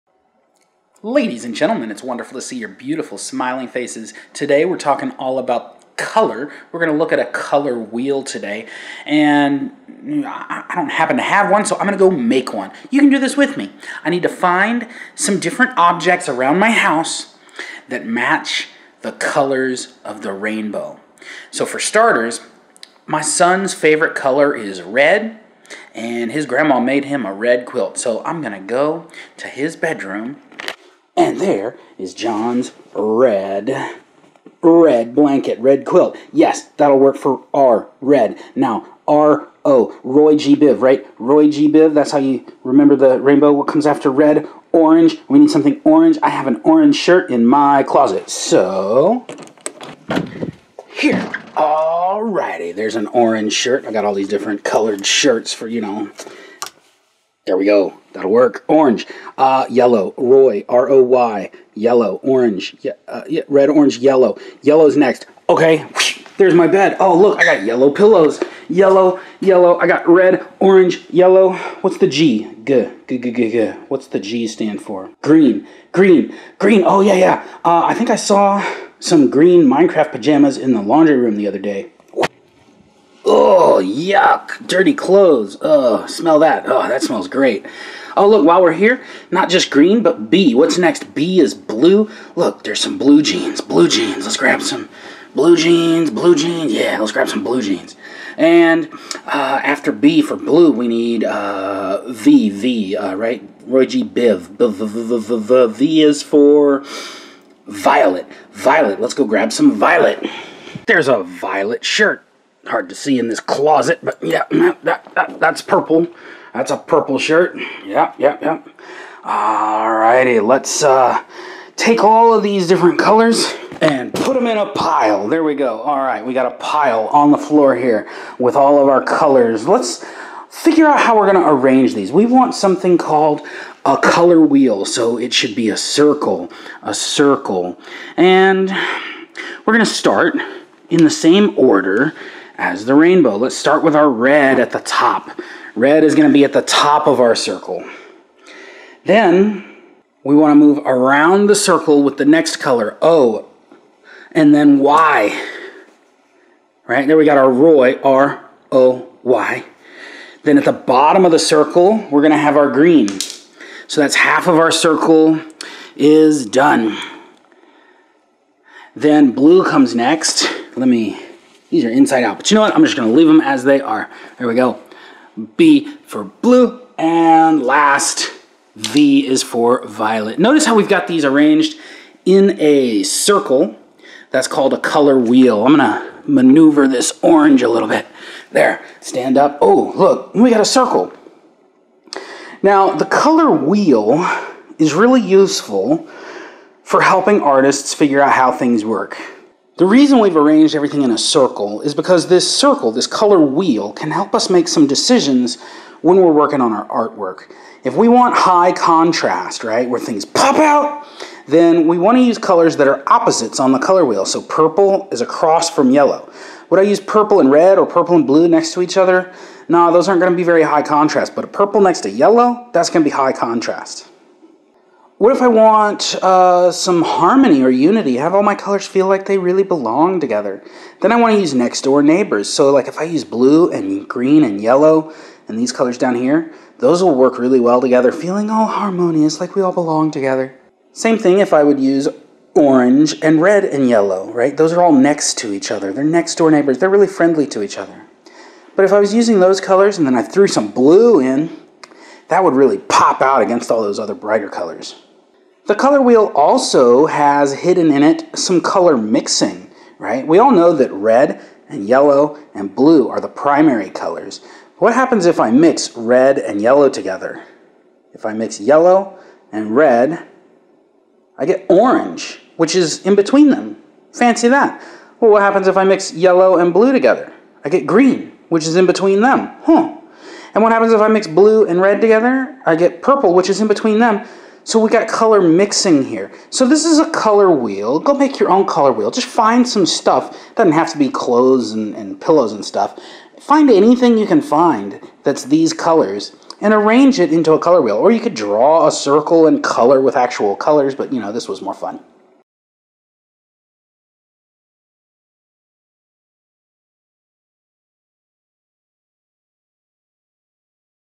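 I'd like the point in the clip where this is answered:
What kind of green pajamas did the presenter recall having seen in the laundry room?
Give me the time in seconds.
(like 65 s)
79 s.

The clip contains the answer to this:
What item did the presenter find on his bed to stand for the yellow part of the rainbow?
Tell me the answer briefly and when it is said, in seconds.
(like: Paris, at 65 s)
Yellow pillows, at 67 s.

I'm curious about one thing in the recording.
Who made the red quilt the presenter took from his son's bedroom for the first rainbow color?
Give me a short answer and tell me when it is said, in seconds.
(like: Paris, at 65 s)
His grandma, at 26 s.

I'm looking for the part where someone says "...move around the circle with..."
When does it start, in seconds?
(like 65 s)
150 s.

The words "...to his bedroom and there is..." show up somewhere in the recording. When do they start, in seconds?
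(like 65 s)
29 s.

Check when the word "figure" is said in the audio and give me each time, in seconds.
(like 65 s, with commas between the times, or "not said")
130 s, 197 s.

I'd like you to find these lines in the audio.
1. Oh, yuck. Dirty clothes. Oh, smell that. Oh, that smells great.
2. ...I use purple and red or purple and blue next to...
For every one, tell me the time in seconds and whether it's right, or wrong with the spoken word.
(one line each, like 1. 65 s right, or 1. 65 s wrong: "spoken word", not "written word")
1. 83 s right
2. 216 s right.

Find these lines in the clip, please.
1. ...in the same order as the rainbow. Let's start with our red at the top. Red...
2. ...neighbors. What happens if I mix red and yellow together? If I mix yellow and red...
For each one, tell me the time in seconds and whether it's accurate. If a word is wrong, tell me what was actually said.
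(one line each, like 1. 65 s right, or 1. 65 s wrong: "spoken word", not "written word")
1. 140 s right
2. 263 s wrong: "colors", not "neighbors".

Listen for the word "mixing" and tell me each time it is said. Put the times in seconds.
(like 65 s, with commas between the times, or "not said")
258 s, 285 s.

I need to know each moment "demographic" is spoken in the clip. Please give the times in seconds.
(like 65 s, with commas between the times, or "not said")
not said.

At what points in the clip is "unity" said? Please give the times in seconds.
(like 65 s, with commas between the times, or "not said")
227 s.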